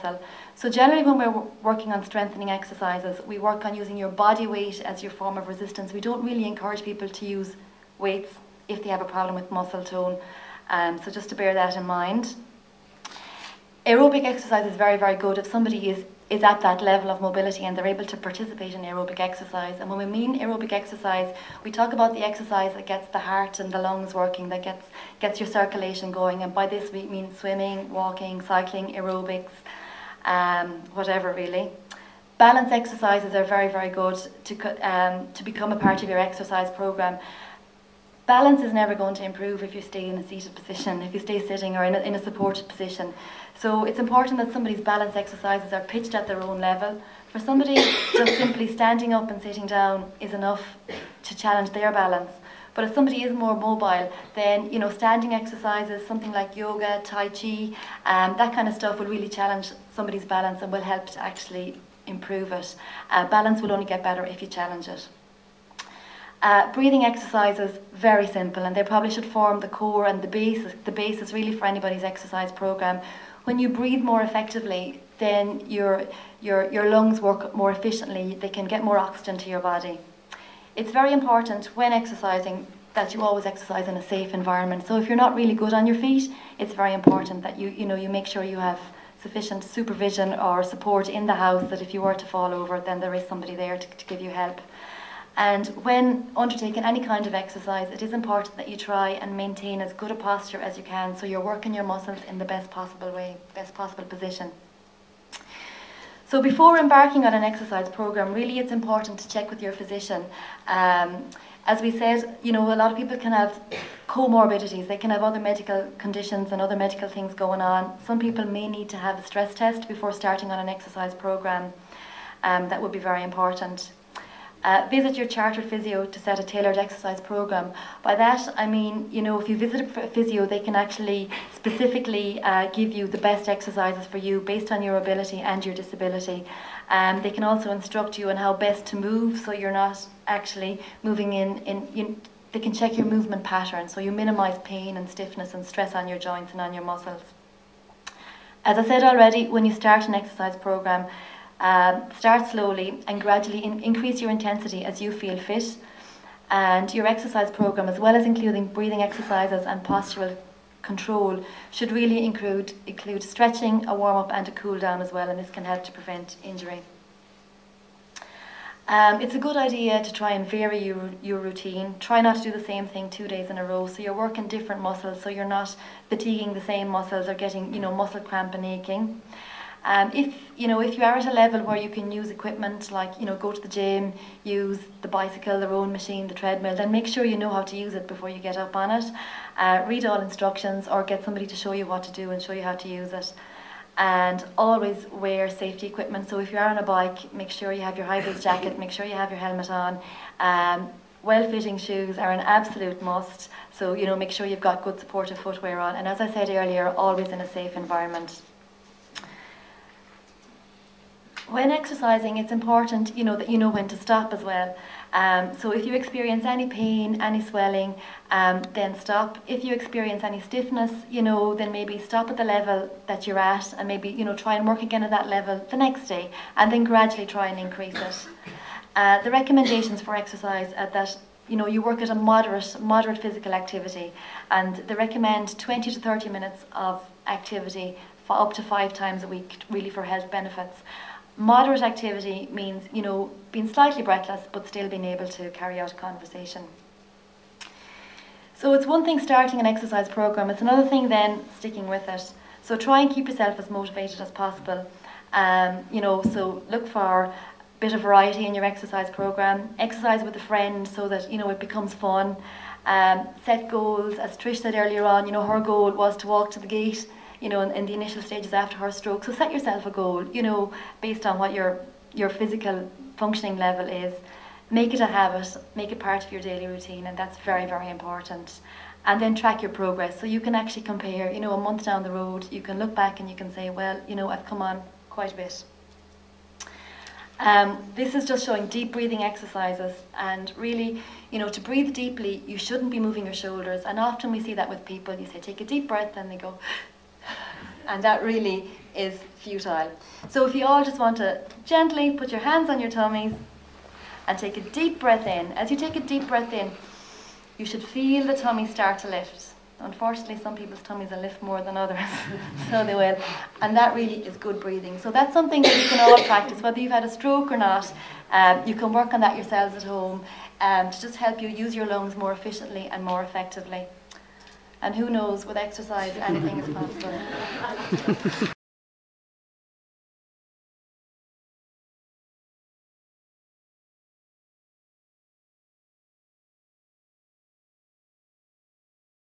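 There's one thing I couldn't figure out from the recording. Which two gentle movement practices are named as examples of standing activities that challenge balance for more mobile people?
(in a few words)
yoga, tai chi.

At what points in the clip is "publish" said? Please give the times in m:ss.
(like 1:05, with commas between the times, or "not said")
not said.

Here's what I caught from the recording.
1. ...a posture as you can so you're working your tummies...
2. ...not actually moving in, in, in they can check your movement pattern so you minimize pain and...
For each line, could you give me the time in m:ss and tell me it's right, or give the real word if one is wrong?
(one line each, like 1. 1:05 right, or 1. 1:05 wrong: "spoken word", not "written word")
1. 1:40 wrong: "muscles", not "tummies"
2. 2:19 right.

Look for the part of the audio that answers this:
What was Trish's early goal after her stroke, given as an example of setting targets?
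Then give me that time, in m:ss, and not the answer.
4:26.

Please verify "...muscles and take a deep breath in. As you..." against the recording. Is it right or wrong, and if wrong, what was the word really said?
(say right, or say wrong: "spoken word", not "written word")
wrong: "tummies", not "muscles".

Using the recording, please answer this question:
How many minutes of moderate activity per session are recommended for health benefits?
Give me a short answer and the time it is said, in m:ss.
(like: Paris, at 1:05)
20 to 30, at 3:55.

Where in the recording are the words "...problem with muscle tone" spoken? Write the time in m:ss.
0:09.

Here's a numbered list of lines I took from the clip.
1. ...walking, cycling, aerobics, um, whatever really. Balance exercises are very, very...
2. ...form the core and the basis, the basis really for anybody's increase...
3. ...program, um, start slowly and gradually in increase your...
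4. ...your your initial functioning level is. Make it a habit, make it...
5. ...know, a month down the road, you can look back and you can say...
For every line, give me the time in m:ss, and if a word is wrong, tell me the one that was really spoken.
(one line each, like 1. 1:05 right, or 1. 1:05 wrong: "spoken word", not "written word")
1. 0:27 right
2. 1:09 wrong: "exercise", not "increase"
3. 2:30 right
4. 4:31 wrong: "physical", not "initial"
5. 4:41 right.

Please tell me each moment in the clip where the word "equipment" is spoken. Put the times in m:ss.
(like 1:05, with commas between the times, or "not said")
3:02, 3:15.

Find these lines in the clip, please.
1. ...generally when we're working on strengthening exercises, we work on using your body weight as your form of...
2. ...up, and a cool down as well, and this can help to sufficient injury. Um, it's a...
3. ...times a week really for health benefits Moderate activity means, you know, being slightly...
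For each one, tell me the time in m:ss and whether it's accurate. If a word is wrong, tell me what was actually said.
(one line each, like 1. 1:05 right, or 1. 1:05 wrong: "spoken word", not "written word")
1. 0:00 right
2. 2:44 wrong: "prevent", not "sufficient"
3. 3:58 right.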